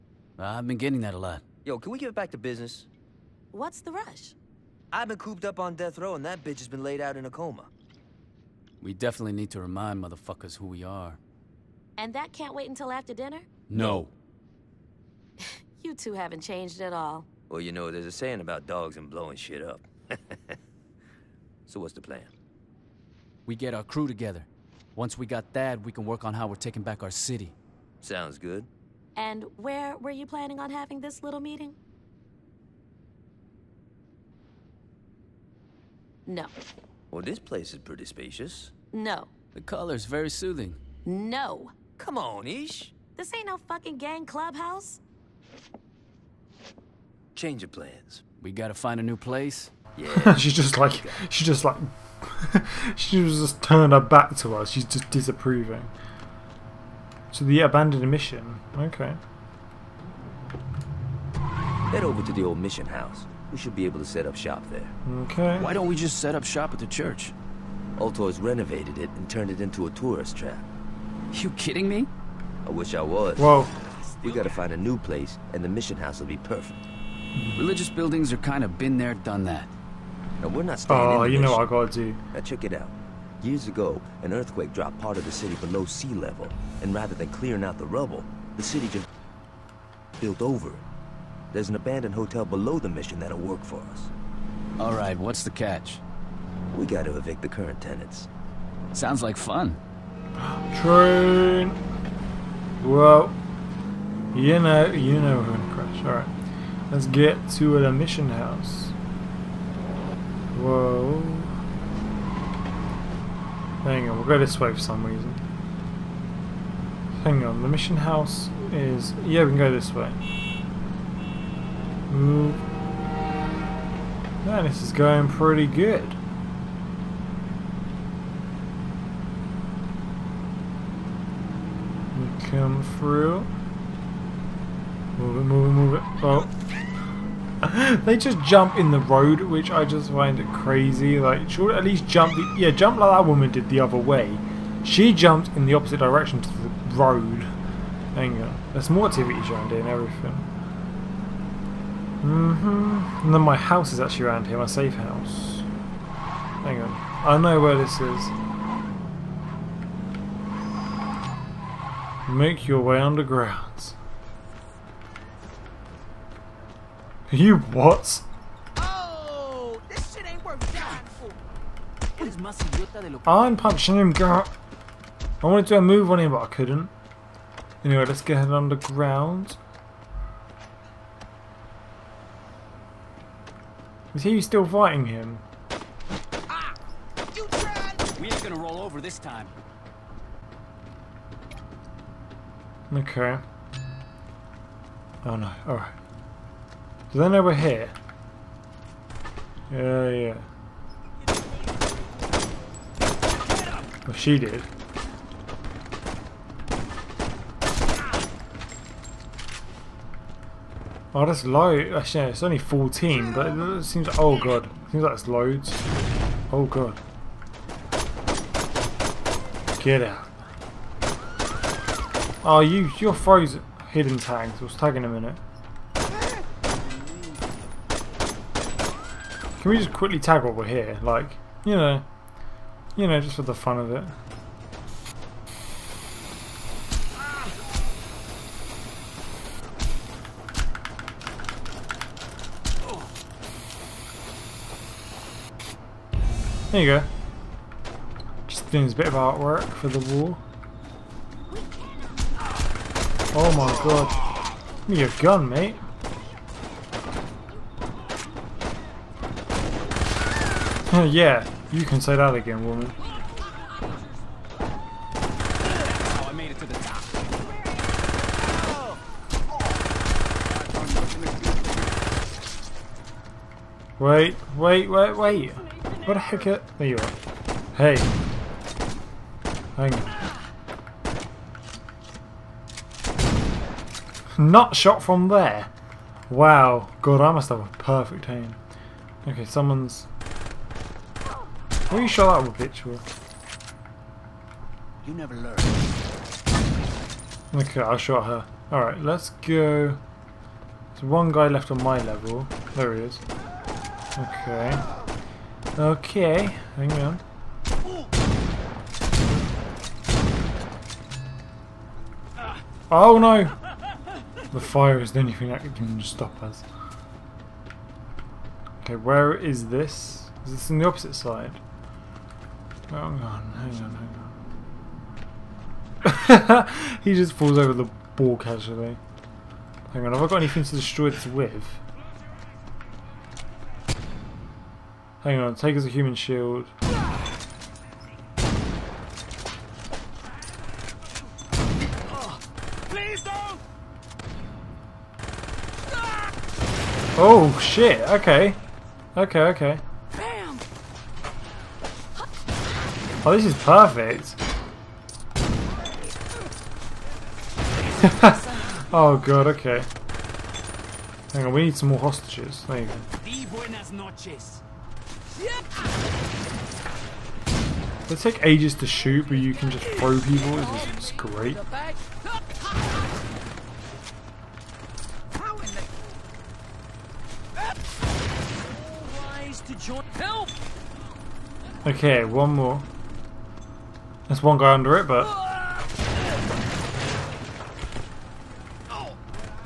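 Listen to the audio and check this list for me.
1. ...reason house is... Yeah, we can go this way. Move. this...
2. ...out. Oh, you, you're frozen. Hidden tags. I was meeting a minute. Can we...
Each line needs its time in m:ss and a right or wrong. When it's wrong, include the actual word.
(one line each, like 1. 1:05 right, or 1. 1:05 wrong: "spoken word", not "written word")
1. 1:57 wrong: "mission", not "reason"
2. 3:40 wrong: "tagging", not "meeting".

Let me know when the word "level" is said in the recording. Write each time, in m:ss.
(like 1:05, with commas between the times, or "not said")
1:26, 5:02.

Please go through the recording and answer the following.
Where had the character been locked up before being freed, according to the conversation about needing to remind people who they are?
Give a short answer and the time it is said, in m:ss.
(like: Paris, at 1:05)
Death row, at 0:05.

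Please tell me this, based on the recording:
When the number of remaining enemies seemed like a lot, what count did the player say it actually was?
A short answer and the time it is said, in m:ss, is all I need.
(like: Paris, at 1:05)
14, at 3:32.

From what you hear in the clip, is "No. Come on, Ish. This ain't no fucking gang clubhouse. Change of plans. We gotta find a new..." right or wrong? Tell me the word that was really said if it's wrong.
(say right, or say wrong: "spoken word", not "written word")
right.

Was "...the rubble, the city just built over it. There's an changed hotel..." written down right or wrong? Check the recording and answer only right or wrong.
wrong.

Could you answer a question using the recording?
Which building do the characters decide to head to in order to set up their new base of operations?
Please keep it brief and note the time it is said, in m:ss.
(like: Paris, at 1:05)
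The old mission house, at 1:02.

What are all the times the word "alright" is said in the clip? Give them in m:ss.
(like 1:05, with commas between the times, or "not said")
3:15, 4:58.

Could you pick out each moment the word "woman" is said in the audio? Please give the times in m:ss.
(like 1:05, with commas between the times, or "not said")
2:23, 4:22.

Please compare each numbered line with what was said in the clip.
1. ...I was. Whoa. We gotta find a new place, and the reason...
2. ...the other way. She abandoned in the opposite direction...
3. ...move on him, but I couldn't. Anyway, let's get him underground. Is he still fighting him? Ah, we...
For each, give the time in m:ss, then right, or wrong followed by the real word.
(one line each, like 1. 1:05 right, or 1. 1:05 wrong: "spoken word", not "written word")
1. 1:12 wrong: "mission", not "reason"
2. 2:23 wrong: "jumped", not "abandoned"
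3. 2:55 right.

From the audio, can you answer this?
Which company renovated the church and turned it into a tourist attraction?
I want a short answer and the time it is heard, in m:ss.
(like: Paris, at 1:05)
Ultor, at 1:07.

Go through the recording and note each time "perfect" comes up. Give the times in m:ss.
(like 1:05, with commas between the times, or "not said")
1:16, 4:47, 5:53.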